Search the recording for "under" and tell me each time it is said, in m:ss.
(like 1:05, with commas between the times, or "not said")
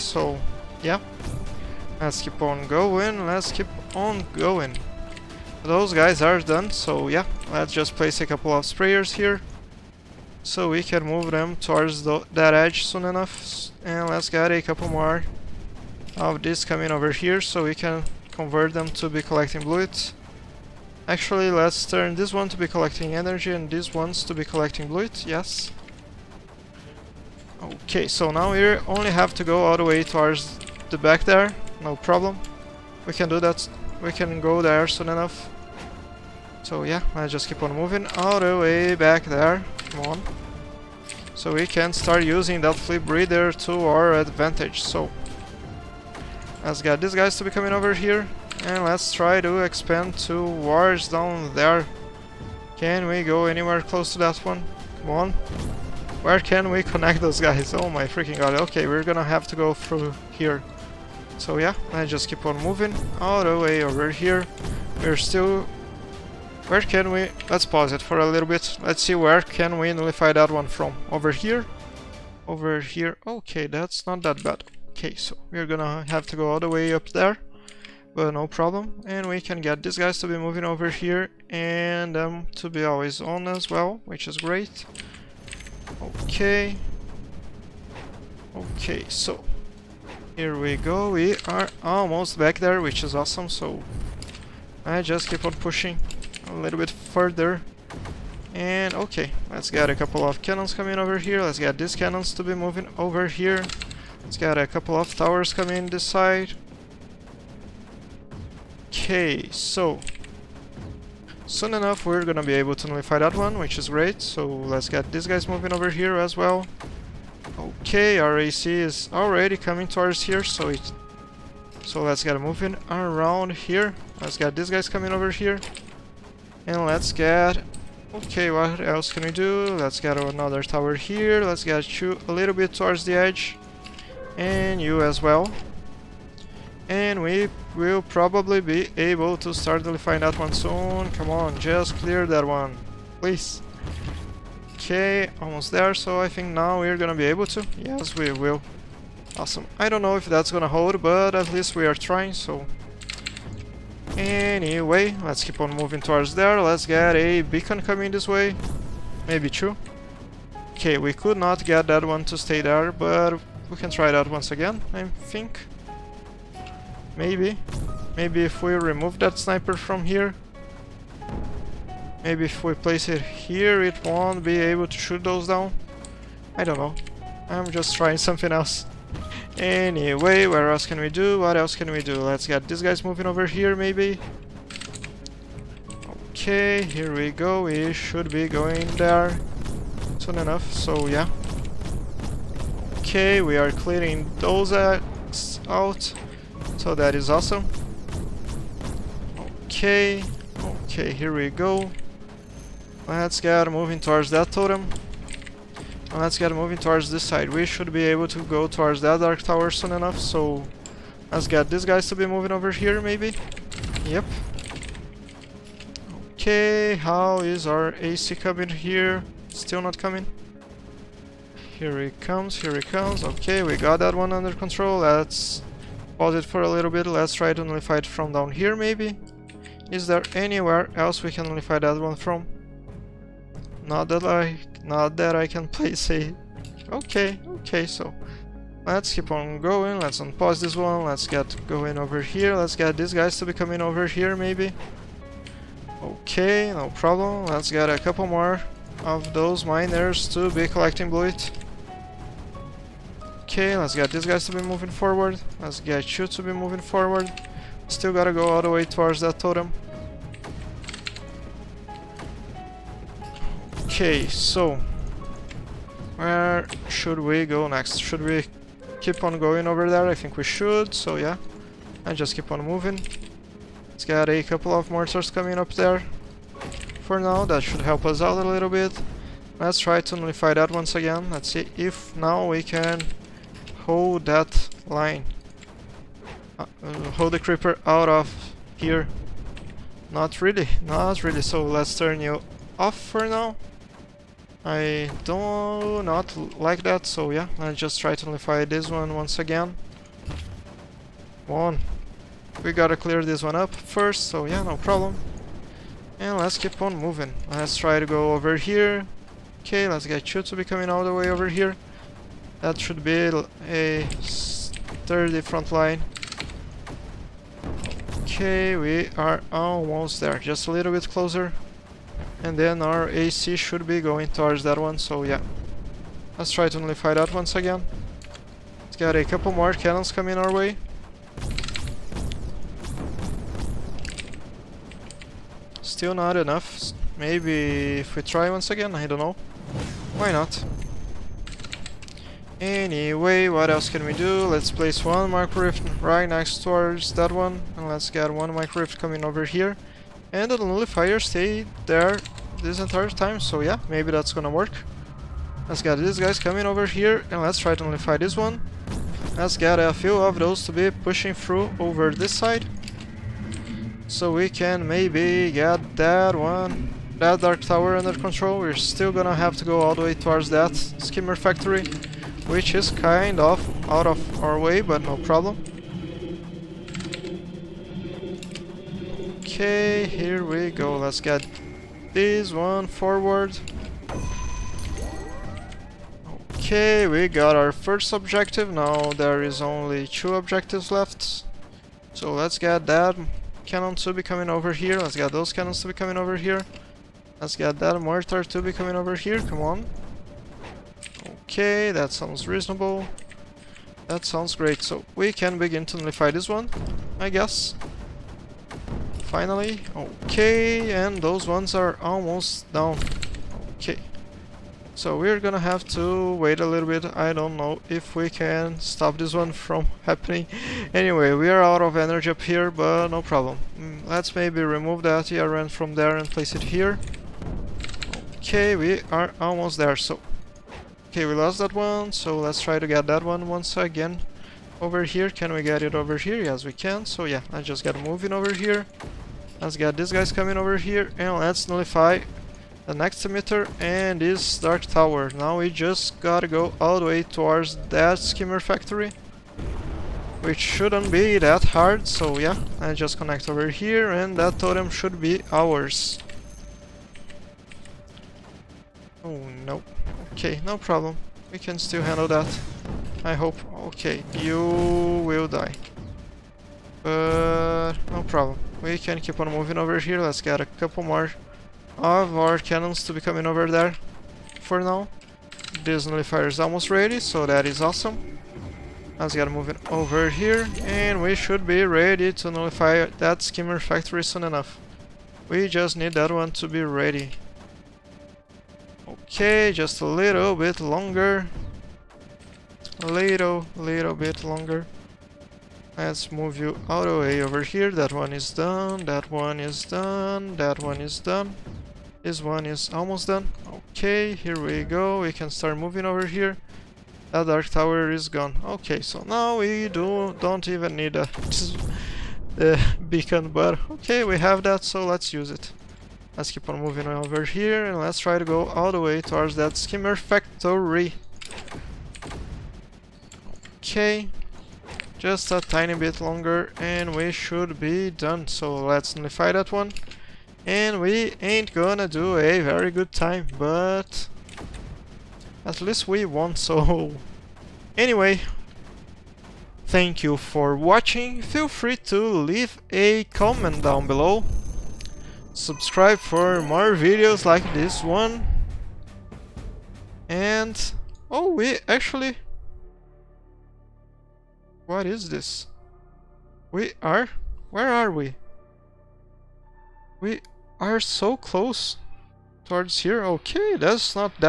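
3:44, 6:07.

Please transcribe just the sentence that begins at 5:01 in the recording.
One, We gotta clear this one up first, so yeah, no problem.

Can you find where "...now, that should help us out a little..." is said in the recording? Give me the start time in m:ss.
4:37.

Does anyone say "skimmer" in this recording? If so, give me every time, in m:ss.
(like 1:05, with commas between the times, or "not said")
6:10, 7:28, 8:03, 8:39.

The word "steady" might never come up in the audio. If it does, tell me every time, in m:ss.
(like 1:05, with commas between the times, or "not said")
not said.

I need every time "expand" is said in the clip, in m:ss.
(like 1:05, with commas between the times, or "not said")
0:49.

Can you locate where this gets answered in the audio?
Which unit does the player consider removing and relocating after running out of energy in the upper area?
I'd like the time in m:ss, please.
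7:05.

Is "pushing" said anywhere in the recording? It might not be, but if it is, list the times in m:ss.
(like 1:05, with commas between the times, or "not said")
1:35, 6:00.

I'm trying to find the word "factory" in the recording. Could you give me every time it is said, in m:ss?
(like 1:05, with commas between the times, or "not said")
6:11, 7:28, 8:03, 8:40.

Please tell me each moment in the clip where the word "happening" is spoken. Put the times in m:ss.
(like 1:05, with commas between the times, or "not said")
7:00.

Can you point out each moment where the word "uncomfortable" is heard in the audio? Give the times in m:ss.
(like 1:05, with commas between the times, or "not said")
not said.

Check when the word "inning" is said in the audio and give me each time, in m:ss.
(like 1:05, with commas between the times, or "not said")
not said.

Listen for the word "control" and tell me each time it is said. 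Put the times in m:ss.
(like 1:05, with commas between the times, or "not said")
3:44, 6:08.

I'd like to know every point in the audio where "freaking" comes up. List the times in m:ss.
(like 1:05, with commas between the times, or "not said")
0:58.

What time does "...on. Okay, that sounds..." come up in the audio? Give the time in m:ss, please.
6:39.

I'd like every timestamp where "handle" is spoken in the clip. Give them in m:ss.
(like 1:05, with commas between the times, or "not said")
7:42.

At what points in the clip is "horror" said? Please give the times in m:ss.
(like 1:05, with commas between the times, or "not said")
not said.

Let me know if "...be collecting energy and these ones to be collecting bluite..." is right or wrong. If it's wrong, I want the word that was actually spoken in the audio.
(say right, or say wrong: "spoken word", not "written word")
right.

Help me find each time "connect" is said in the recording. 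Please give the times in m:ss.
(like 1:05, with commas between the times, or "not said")
0:56, 7:33.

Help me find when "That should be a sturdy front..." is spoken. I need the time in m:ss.
5:12.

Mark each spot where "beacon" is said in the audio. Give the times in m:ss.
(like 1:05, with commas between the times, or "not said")
2:37, 8:33.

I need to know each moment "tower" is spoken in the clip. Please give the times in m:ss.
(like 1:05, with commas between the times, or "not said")
1:45, 2:10, 3:29, 6:07, 7:24, 8:27.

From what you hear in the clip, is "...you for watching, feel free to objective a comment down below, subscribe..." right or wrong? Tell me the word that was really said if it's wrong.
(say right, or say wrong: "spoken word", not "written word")
wrong: "leave", not "objective".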